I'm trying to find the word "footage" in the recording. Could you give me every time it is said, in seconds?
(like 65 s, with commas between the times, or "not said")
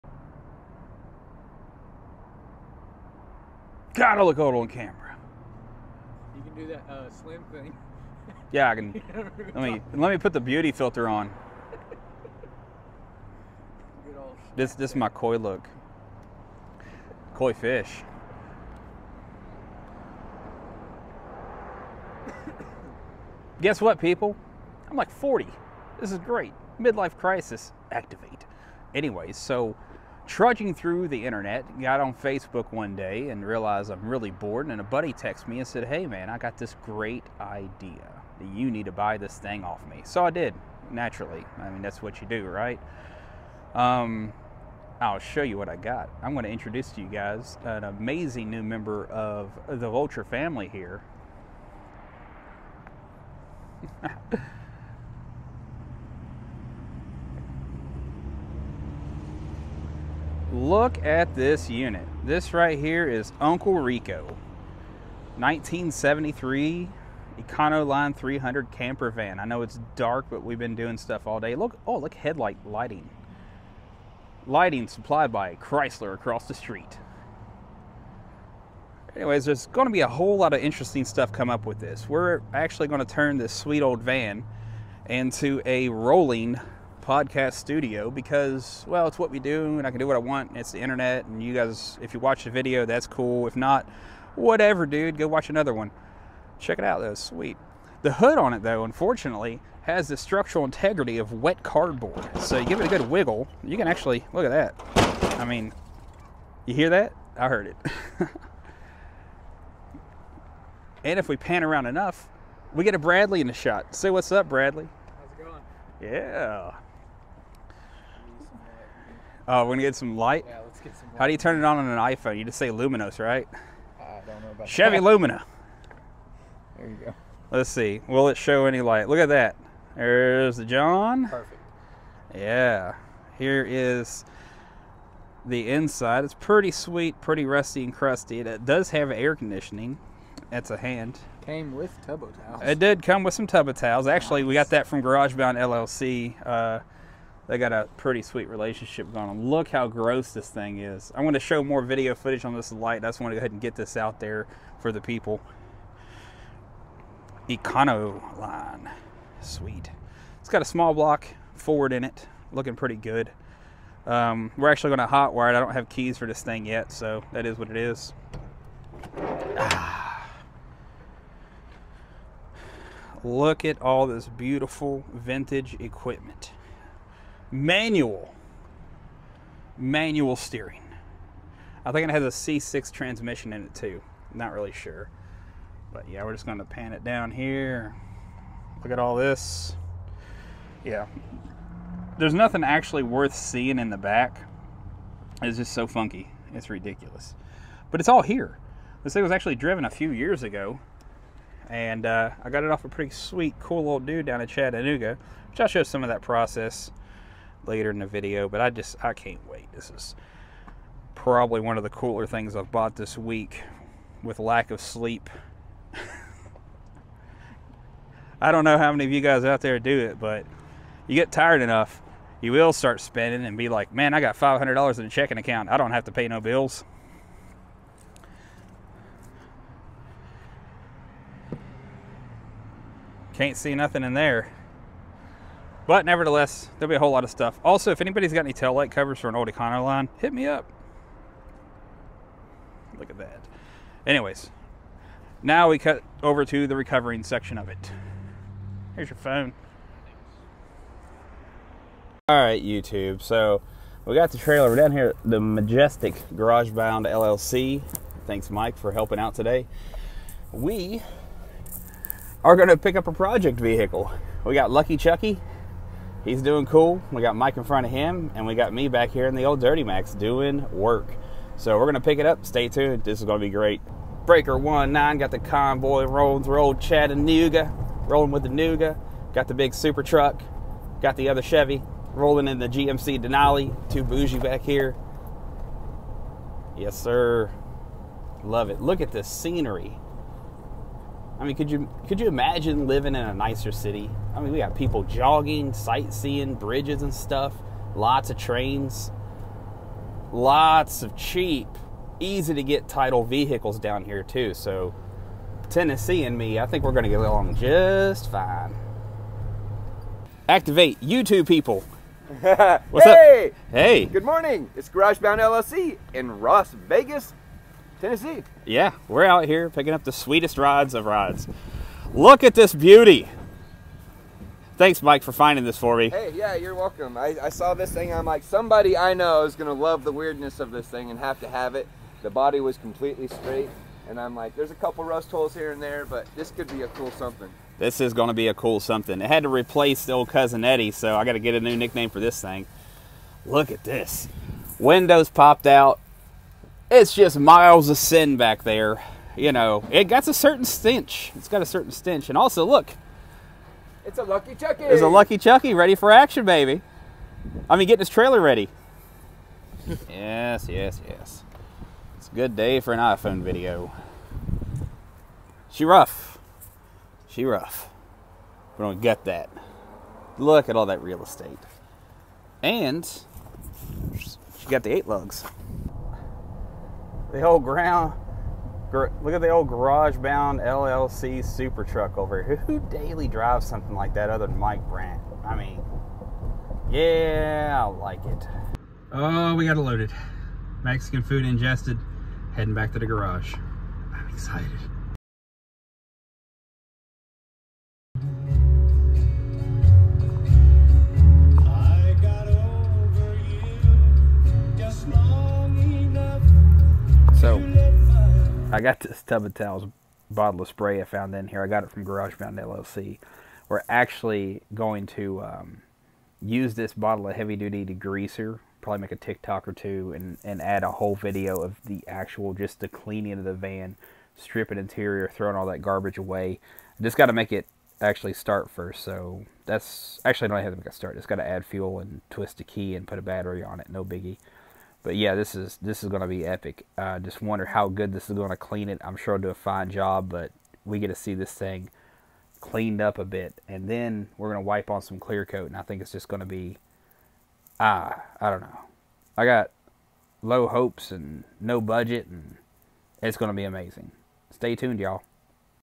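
152 s.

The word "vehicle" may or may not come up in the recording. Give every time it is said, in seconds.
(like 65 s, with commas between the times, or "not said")
263 s, 303 s.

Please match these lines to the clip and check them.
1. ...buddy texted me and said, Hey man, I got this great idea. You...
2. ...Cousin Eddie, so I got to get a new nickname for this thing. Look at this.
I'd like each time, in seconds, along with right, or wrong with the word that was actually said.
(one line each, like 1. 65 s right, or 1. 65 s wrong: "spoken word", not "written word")
1. 34 s right
2. 340 s right.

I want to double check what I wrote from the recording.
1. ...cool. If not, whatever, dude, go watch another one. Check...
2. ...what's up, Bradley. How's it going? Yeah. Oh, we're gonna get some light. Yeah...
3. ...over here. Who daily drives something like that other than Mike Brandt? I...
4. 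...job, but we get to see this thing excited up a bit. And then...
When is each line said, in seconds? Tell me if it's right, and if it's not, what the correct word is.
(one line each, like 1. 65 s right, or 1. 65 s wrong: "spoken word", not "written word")
1. 93 s right
2. 114 s right
3. 382 s right
4. 439 s wrong: "cleaned", not "excited".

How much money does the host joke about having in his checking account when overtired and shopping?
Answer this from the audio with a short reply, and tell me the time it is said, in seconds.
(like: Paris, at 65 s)
$500, at 224 s.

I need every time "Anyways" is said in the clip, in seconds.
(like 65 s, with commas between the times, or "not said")
28 s, 79 s, 244 s.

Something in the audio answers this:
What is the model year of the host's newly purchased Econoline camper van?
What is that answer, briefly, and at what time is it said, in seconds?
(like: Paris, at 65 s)
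1973, at 65 s.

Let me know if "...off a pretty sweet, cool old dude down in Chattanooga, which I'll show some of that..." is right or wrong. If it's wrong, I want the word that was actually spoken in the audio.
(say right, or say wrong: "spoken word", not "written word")
right.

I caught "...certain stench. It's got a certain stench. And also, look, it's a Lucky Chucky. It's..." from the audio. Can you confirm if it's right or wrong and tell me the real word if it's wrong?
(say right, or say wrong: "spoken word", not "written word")
right.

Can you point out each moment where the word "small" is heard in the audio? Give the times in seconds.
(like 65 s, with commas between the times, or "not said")
160 s.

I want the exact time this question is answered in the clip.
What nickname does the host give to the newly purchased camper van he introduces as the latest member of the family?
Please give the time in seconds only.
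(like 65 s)
63 s.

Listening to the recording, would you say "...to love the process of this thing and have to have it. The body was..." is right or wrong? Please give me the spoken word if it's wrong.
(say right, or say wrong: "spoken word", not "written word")
wrong: "weirdness", not "process".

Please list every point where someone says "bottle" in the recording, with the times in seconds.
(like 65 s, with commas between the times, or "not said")
410 s, 416 s.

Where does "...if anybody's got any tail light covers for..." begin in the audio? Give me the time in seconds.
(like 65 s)
237 s.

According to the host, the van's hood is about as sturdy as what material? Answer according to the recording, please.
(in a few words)
wet cardboard.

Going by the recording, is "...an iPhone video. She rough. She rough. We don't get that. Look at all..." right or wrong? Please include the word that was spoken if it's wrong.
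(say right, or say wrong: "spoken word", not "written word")
right.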